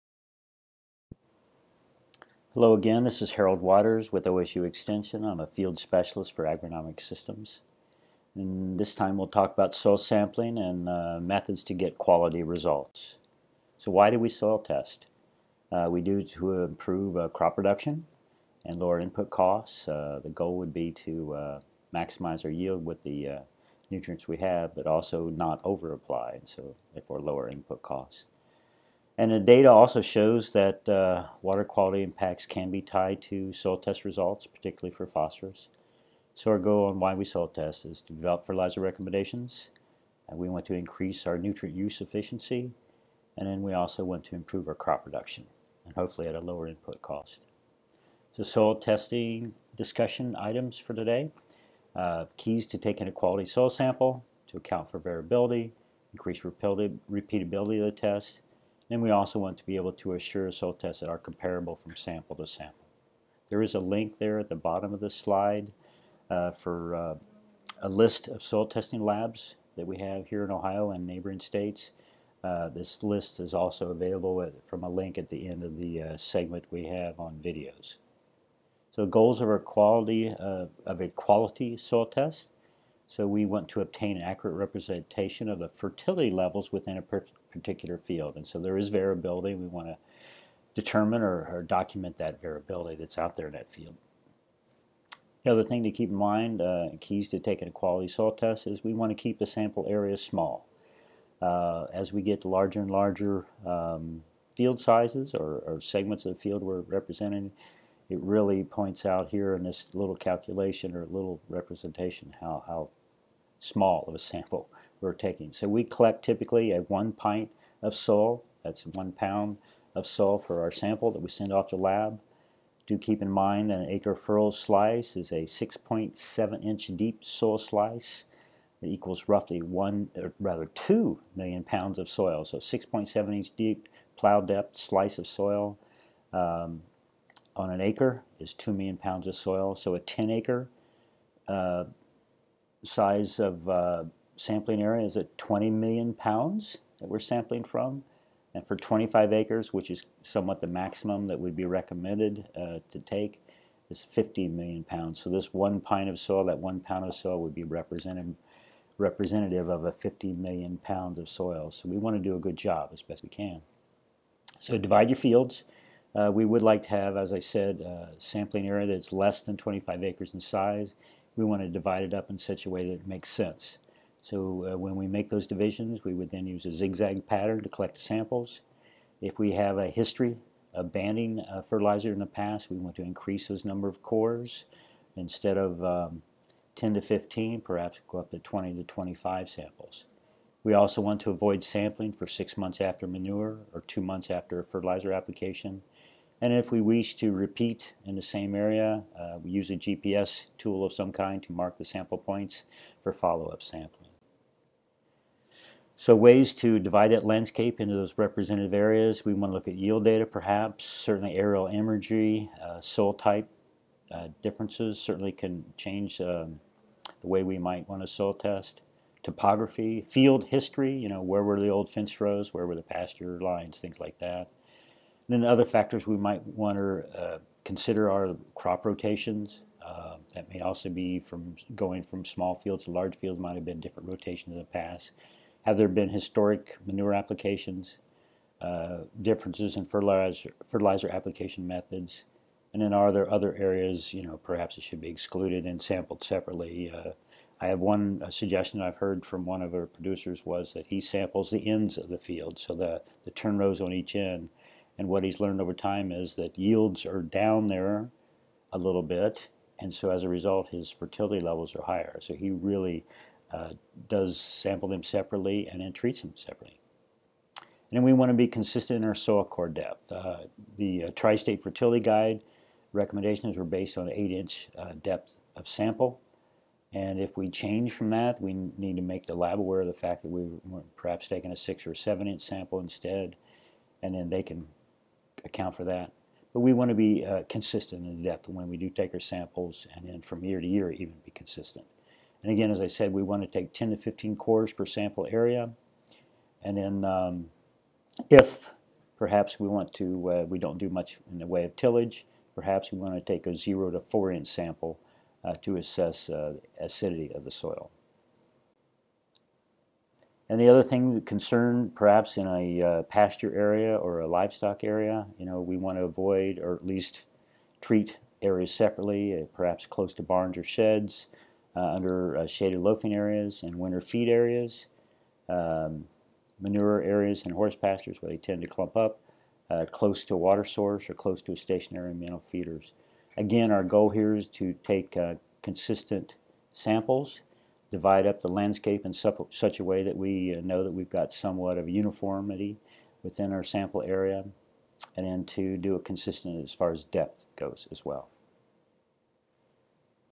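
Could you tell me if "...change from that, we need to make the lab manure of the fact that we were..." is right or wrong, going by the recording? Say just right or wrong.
wrong.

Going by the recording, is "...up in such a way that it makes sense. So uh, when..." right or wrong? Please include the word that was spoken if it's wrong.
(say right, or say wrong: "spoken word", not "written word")
right.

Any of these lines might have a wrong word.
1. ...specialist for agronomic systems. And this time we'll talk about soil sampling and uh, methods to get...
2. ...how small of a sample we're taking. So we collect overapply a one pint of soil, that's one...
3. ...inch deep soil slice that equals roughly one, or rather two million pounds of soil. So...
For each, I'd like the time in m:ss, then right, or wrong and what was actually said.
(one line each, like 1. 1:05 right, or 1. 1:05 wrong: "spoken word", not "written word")
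1. 0:05 right
2. 1:52 wrong: "typically", not "overapply"
3. 2:06 right.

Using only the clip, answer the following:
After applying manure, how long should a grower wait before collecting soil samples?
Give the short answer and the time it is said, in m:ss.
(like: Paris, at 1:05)
6 months, at 3:12.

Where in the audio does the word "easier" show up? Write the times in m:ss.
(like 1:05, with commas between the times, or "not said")
not said.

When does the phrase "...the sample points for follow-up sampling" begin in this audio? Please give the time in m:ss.
3:21.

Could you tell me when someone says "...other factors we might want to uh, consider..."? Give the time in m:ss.
3:45.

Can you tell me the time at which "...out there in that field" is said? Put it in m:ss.
1:33.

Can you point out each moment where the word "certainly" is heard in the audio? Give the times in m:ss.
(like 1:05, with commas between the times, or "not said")
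3:30, 3:34.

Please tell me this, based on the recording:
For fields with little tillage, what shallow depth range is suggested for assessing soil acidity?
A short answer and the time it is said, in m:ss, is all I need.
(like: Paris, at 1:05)
0 to 4 inches, at 5:03.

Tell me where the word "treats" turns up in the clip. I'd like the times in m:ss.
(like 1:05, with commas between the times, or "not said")
4:25, 5:17.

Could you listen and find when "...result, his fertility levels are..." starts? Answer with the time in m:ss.
4:20.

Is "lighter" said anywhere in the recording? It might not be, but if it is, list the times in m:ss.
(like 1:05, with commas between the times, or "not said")
not said.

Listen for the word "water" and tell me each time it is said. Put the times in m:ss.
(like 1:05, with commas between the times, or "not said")
0:03, 0:31, 5:30.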